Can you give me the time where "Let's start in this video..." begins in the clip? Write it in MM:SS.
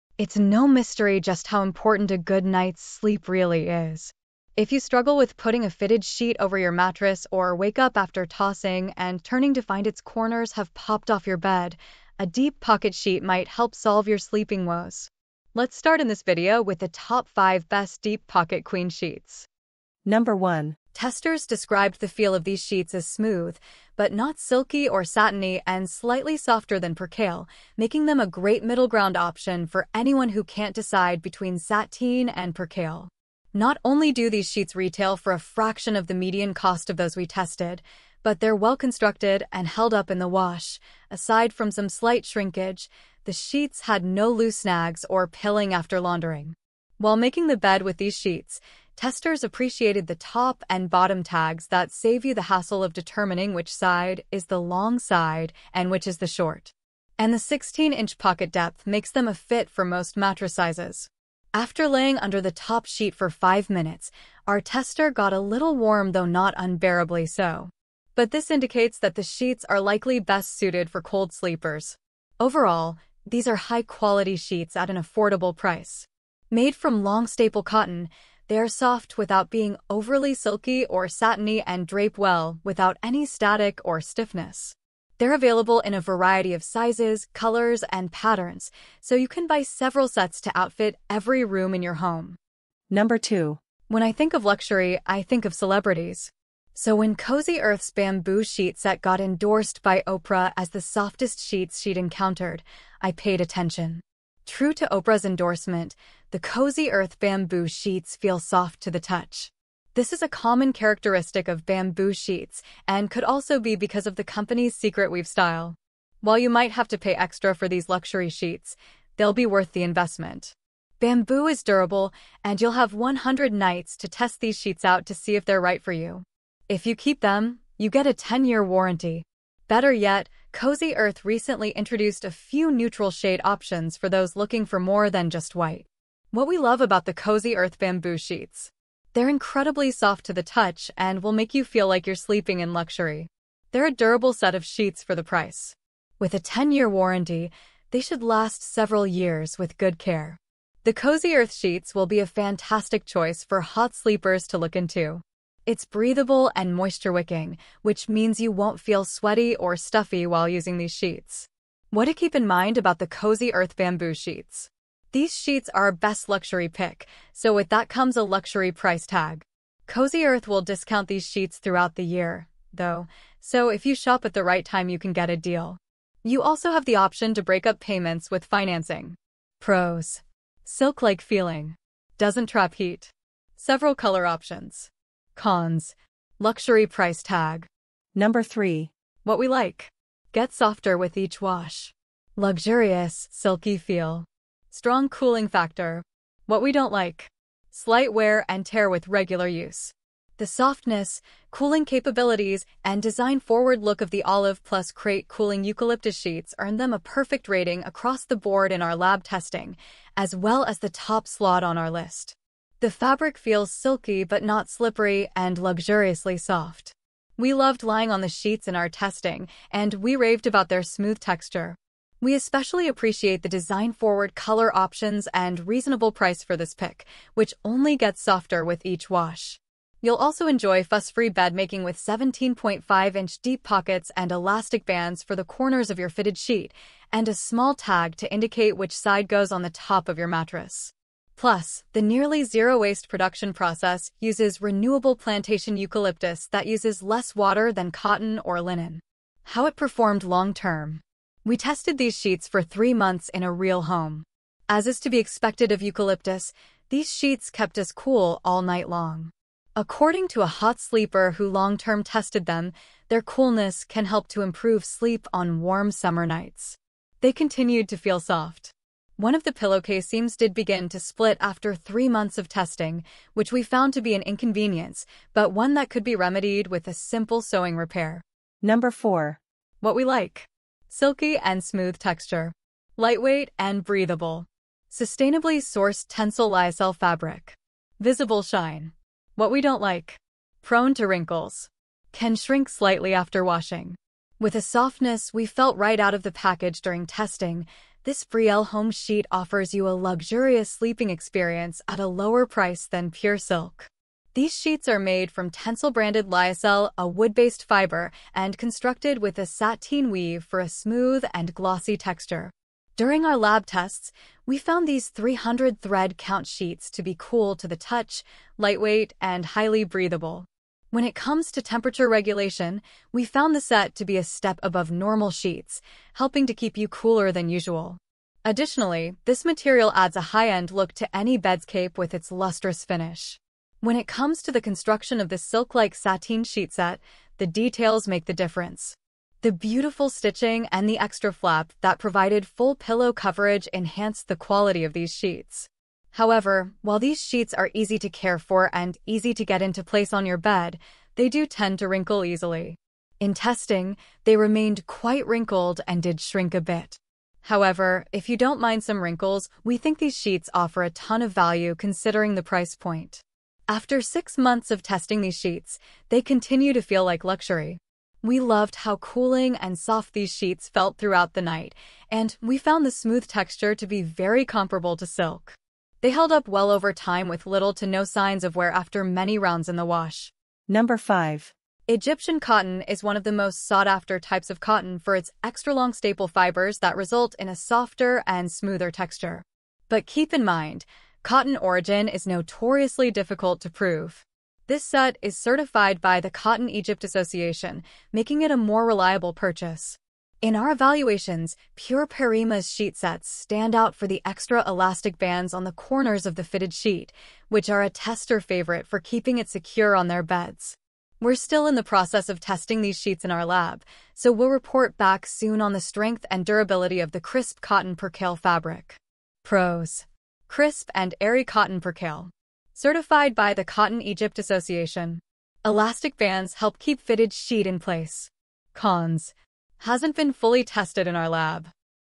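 00:15.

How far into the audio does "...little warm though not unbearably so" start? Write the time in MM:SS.
01:05.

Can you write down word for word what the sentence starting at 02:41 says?
What to keep in mind about the Cozy Earth Bamboo Sheets.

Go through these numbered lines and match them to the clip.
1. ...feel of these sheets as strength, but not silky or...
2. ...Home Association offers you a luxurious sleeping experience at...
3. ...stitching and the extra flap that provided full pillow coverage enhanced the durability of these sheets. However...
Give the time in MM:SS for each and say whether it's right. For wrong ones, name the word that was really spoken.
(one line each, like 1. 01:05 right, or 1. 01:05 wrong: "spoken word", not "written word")
1. 00:22 wrong: "smooth", not "strength"
2. 04:58 wrong: "Sheet", not "Association"
3. 05:40 wrong: "quality", not "durability".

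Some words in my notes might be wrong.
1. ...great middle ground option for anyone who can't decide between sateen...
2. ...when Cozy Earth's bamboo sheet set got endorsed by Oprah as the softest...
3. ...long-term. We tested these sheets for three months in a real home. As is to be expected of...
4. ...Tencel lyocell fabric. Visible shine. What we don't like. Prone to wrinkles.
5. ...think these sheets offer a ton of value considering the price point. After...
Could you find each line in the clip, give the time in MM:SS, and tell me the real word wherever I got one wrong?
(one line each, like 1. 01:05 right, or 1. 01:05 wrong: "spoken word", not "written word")
1. 00:28 right
2. 01:36 right
3. 04:10 right
4. 04:46 right
5. 05:59 right.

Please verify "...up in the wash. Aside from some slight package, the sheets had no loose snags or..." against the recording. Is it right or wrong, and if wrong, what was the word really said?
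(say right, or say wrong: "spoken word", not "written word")
wrong: "shrinkage", not "package".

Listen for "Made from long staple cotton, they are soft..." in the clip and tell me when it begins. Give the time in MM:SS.
01:16.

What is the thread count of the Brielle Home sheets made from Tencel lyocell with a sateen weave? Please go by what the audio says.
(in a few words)
300.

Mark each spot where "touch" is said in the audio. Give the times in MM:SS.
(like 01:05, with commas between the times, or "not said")
01:48, 02:20, 05:17.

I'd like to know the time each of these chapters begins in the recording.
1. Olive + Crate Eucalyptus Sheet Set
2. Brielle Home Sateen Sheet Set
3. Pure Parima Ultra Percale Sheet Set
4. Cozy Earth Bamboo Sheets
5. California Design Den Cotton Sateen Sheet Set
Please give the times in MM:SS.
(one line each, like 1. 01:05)
1. 03:07
2. 04:38
3. 06:20
4. 01:32
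5. 00:19.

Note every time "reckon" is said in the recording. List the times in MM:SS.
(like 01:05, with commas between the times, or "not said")
not said.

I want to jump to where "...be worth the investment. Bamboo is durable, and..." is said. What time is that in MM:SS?
01:59.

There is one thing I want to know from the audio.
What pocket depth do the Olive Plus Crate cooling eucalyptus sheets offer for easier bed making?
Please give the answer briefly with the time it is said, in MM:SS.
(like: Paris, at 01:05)
17.5 inches, at 03:51.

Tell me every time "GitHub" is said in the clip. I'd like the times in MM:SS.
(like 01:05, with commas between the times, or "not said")
not said.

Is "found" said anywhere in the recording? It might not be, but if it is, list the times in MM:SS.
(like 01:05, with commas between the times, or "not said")
04:33, 05:14, 05:23, 06:12.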